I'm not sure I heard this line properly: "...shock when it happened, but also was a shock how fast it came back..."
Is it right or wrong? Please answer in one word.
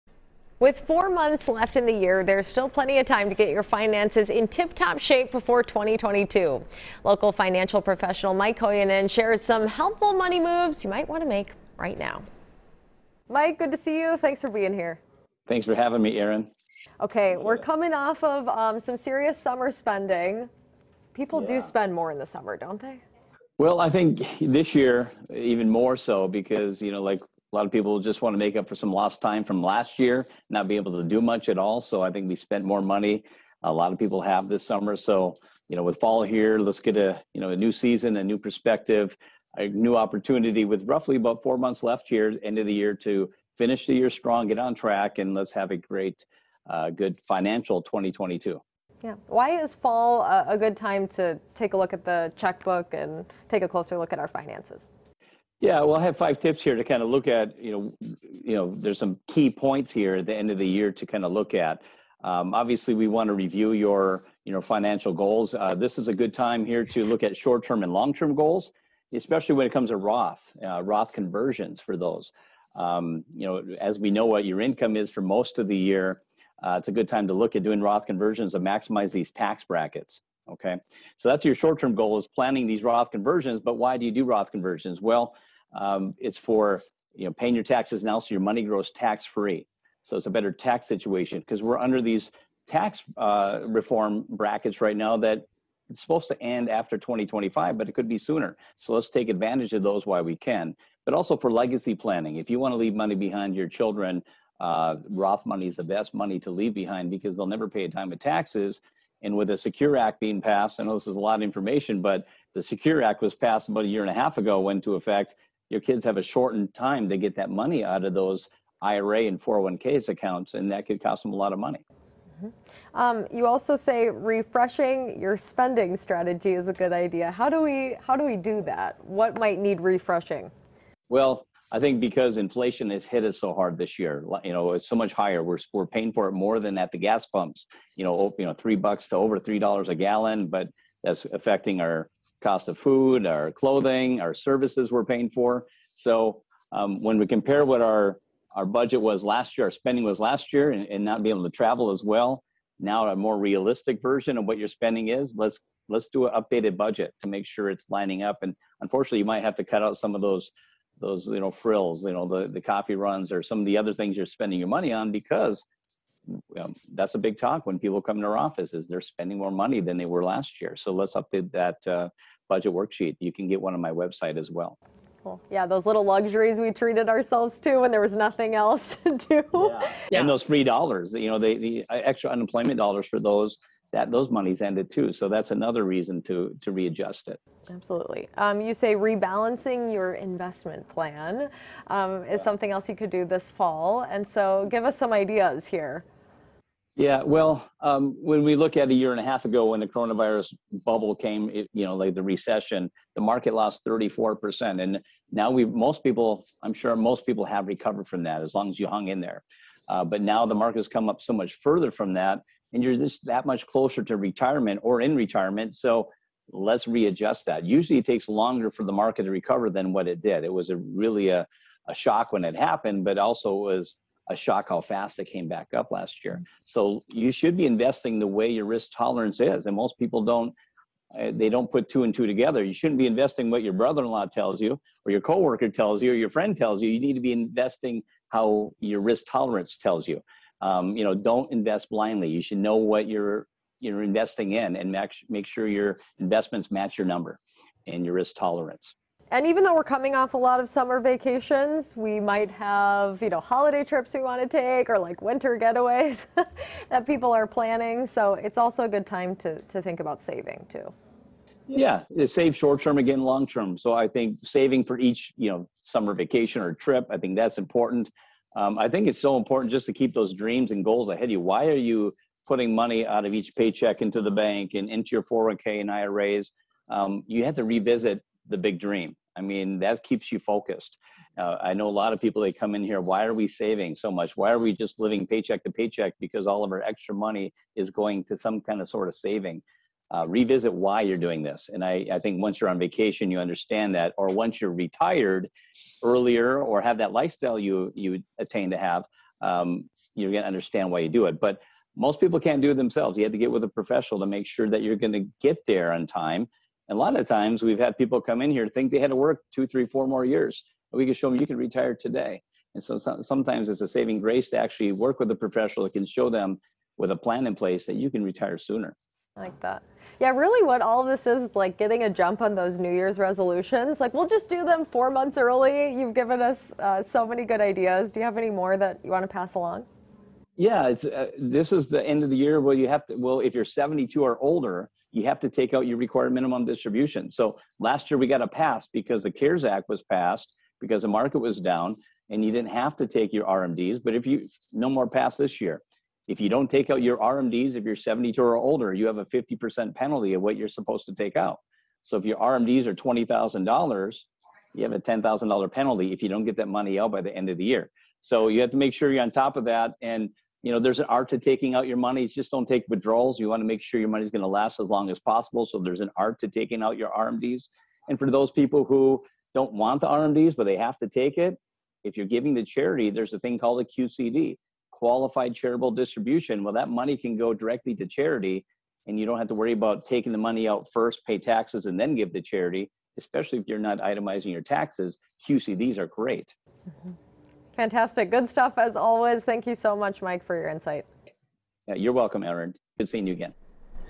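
right.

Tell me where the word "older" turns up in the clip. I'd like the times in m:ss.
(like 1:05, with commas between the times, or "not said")
5:34, 5:48.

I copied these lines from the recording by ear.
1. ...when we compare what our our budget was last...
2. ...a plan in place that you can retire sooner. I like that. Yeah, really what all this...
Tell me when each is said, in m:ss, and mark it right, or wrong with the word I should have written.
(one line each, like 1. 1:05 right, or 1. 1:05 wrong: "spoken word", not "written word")
1. 2:27 right
2. 5:17 right.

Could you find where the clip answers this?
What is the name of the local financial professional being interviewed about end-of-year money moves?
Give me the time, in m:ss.
0:08.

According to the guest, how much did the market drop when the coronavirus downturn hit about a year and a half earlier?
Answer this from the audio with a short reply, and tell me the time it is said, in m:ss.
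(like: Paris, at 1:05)
34%, at 3:23.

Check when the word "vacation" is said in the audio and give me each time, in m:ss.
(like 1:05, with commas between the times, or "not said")
4:10, 4:26, 4:52.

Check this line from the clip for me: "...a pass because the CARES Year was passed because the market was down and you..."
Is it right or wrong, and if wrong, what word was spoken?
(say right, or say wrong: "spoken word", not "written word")
wrong: "Act", not "Year".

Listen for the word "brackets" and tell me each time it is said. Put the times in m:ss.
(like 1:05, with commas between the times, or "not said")
1:19, 1:34.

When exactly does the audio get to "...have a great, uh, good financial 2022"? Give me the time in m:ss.
0:45.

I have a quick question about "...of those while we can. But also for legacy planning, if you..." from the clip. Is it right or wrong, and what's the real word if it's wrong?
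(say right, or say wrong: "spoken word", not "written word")
right.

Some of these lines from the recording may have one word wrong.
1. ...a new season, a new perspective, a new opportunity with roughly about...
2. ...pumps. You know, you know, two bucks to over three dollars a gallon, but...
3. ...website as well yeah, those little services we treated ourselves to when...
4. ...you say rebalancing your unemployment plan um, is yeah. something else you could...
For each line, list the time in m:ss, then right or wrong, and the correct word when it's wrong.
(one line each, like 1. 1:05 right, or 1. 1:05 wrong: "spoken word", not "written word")
1. 0:37 right
2. 2:17 wrong: "three", not "two"
3. 2:53 wrong: "luxuries", not "services"
4. 3:08 wrong: "investment", not "unemployment".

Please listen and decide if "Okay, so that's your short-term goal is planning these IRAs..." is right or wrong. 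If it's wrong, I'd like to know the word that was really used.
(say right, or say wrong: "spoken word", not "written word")
wrong: "Roth", not "IRAs".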